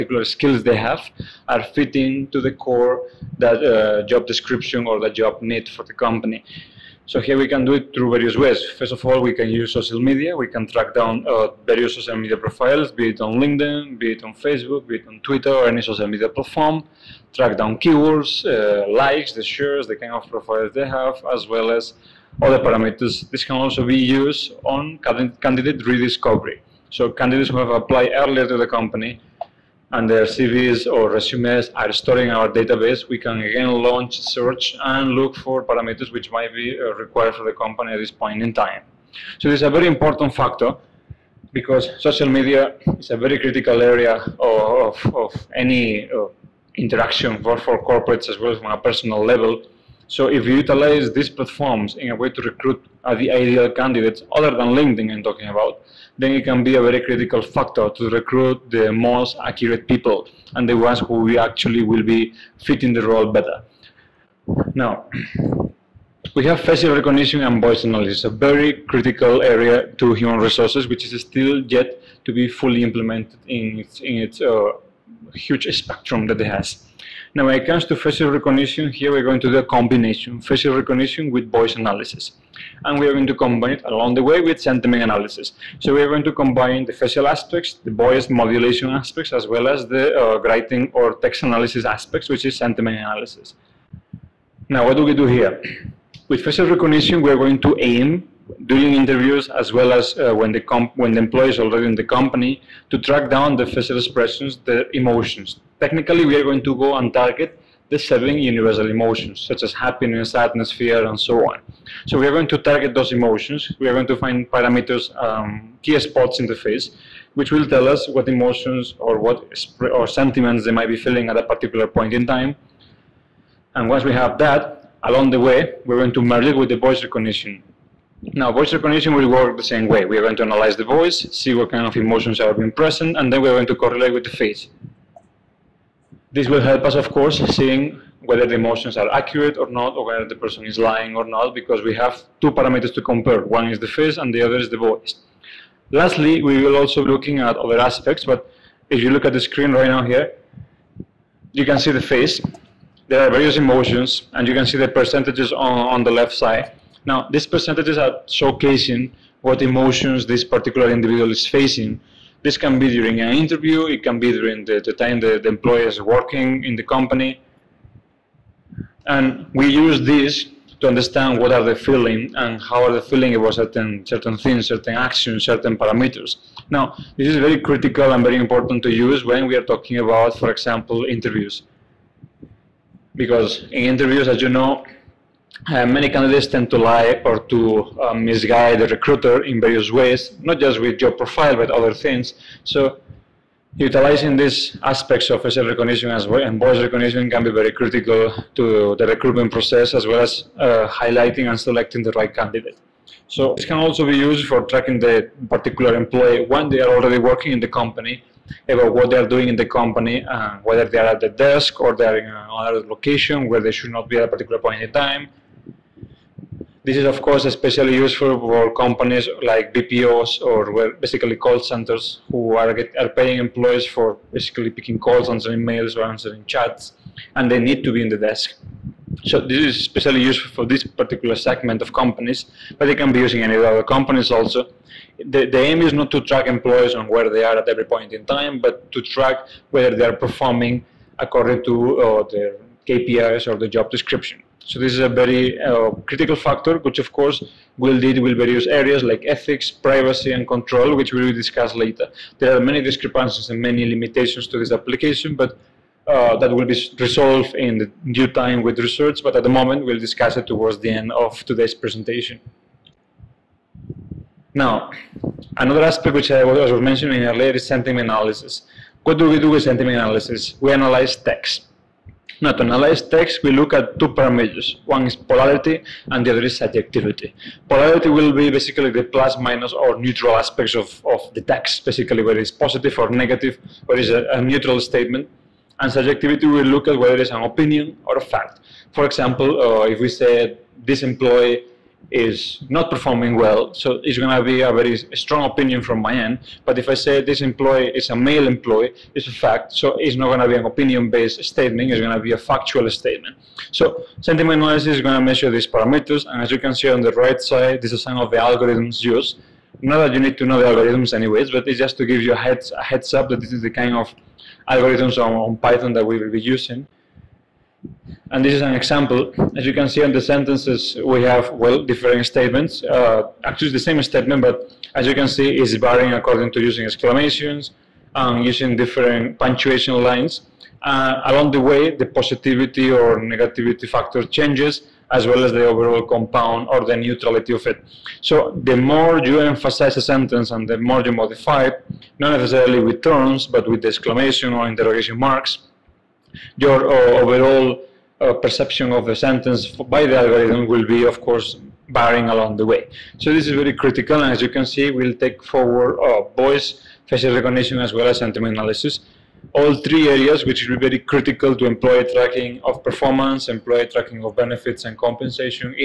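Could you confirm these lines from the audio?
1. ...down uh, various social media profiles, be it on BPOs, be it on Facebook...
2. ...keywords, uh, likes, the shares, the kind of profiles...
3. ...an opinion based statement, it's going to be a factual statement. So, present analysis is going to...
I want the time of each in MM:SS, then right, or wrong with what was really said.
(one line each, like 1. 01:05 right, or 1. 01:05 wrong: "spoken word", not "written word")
1. 00:10 wrong: "LinkedIn", not "BPOs"
2. 00:17 right
3. 05:00 wrong: "sentiment", not "present".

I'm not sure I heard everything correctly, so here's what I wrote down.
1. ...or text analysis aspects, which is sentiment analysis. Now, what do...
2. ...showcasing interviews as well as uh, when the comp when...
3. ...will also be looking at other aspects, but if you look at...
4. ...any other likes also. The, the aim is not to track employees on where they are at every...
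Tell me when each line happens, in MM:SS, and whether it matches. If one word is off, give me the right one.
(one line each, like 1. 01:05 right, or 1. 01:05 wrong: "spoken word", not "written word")
1. 01:30 right
2. 01:38 wrong: "during", not "showcasing"
3. 02:26 right
4. 03:53 wrong: "companies", not "likes".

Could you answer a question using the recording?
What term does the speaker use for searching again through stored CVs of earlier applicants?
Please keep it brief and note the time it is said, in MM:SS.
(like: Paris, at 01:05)
candidate rediscovery, at 00:25.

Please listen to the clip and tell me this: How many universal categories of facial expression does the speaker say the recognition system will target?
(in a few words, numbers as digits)
7.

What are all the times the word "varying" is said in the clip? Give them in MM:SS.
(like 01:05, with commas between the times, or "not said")
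05:25, 05:51.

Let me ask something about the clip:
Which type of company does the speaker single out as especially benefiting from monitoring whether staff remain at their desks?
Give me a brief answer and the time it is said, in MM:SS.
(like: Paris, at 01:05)
BPOs, at 03:39.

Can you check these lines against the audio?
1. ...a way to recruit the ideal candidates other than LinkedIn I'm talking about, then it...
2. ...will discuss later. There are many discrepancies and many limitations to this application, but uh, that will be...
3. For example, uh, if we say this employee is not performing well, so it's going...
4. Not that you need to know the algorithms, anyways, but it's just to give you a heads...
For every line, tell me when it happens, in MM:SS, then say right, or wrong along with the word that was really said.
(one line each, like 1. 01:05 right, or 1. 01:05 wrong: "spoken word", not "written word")
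1. 00:52 right
2. 04:11 right
3. 04:48 right
4. 05:09 right.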